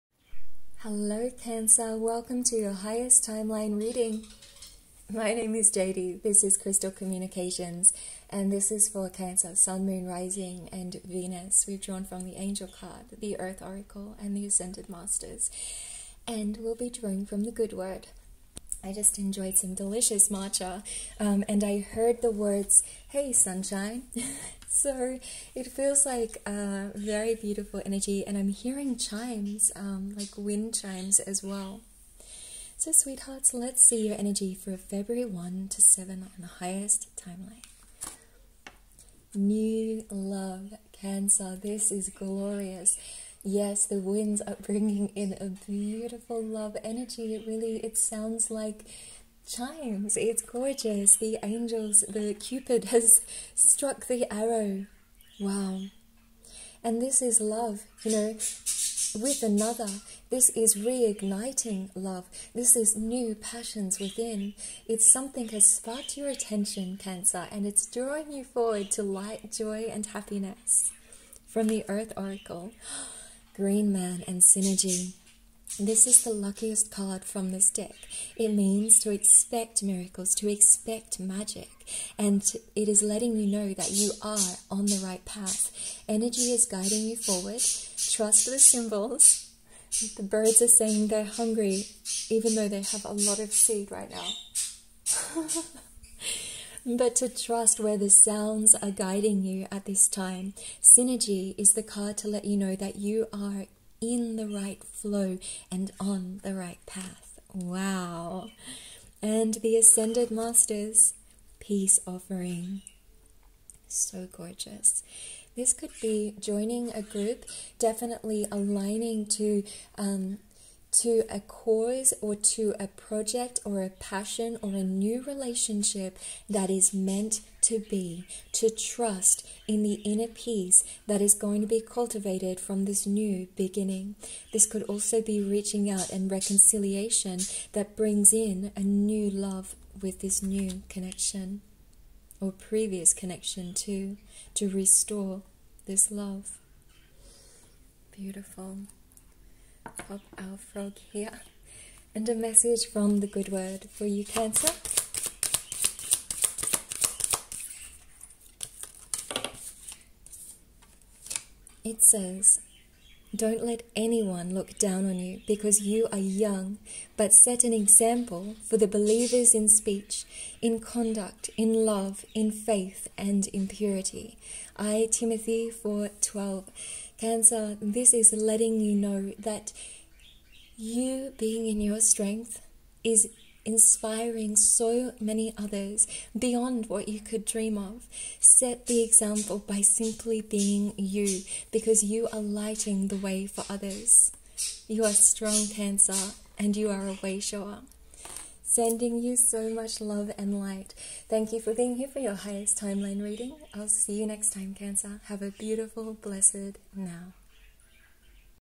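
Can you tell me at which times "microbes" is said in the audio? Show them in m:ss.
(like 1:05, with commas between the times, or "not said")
not said.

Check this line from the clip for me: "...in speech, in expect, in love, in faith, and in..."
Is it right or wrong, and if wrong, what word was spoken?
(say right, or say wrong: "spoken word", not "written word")
wrong: "conduct", not "expect".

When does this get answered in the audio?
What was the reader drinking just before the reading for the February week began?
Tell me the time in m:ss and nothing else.
0:20.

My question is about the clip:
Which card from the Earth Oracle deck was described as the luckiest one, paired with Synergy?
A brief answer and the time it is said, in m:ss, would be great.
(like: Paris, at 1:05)
Green Man, at 1:13.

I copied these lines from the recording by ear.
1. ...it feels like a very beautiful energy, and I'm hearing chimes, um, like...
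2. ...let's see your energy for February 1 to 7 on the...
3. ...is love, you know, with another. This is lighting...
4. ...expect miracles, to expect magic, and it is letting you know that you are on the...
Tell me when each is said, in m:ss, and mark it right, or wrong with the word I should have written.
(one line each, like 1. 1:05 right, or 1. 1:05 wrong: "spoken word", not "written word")
1. 0:25 right
2. 0:33 right
3. 0:57 wrong: "reigniting", not "lighting"
4. 1:19 right.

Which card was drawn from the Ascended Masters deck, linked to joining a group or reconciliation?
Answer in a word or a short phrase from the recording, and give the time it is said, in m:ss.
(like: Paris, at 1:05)
Peace offering, at 1:51.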